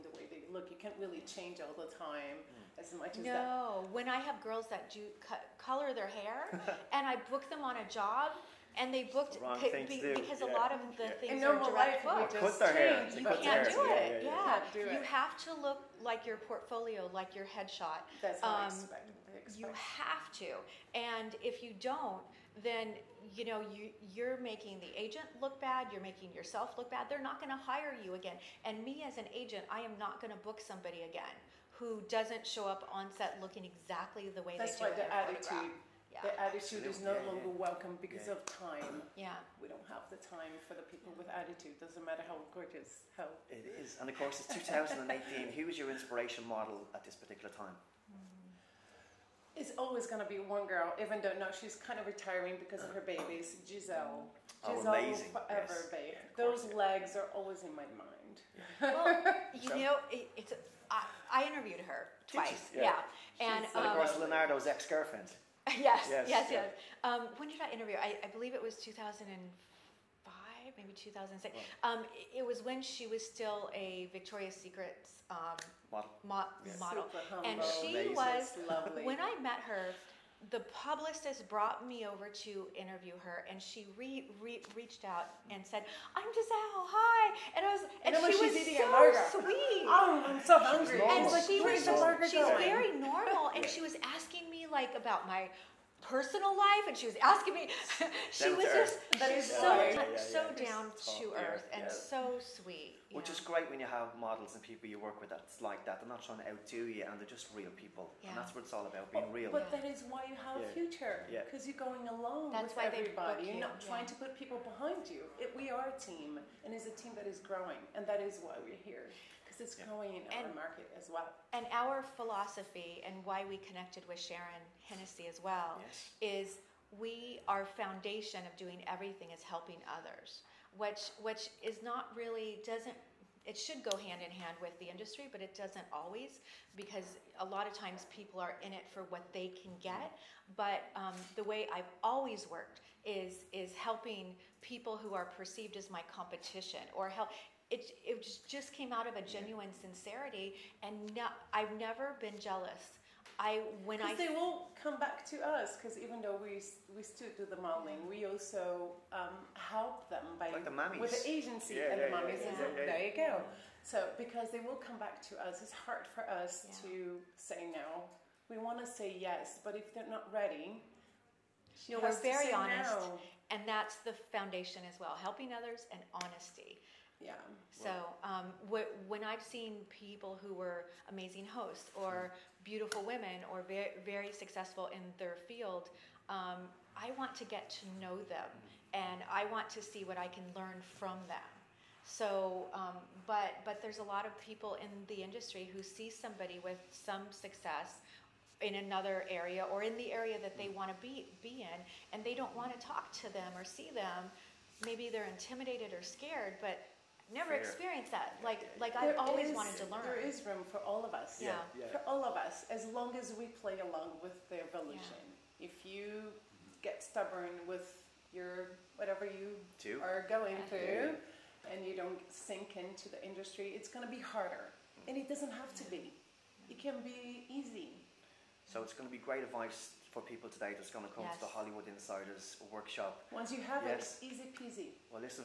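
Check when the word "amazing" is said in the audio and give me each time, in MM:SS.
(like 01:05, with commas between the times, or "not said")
00:54, 01:17, 03:01.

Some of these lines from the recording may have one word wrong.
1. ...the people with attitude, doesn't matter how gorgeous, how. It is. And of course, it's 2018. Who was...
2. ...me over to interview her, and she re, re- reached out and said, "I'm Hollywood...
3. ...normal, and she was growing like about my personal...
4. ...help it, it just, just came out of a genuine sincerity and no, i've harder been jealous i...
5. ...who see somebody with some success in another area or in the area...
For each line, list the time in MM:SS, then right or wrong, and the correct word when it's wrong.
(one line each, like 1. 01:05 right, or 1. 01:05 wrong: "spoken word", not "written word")
1. 00:40 right
2. 01:21 wrong: "Gisele", not "Hollywood"
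3. 01:32 wrong: "asking", not "growing"
4. 02:27 wrong: "never", not "harder"
5. 03:15 right.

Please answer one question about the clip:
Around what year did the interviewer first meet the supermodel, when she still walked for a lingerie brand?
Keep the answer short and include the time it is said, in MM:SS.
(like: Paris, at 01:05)
2005, at 01:08.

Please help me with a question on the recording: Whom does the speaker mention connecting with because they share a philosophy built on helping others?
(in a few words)
Sharon Hennessy.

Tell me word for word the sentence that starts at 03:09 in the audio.
and I want to see what I can learn from them.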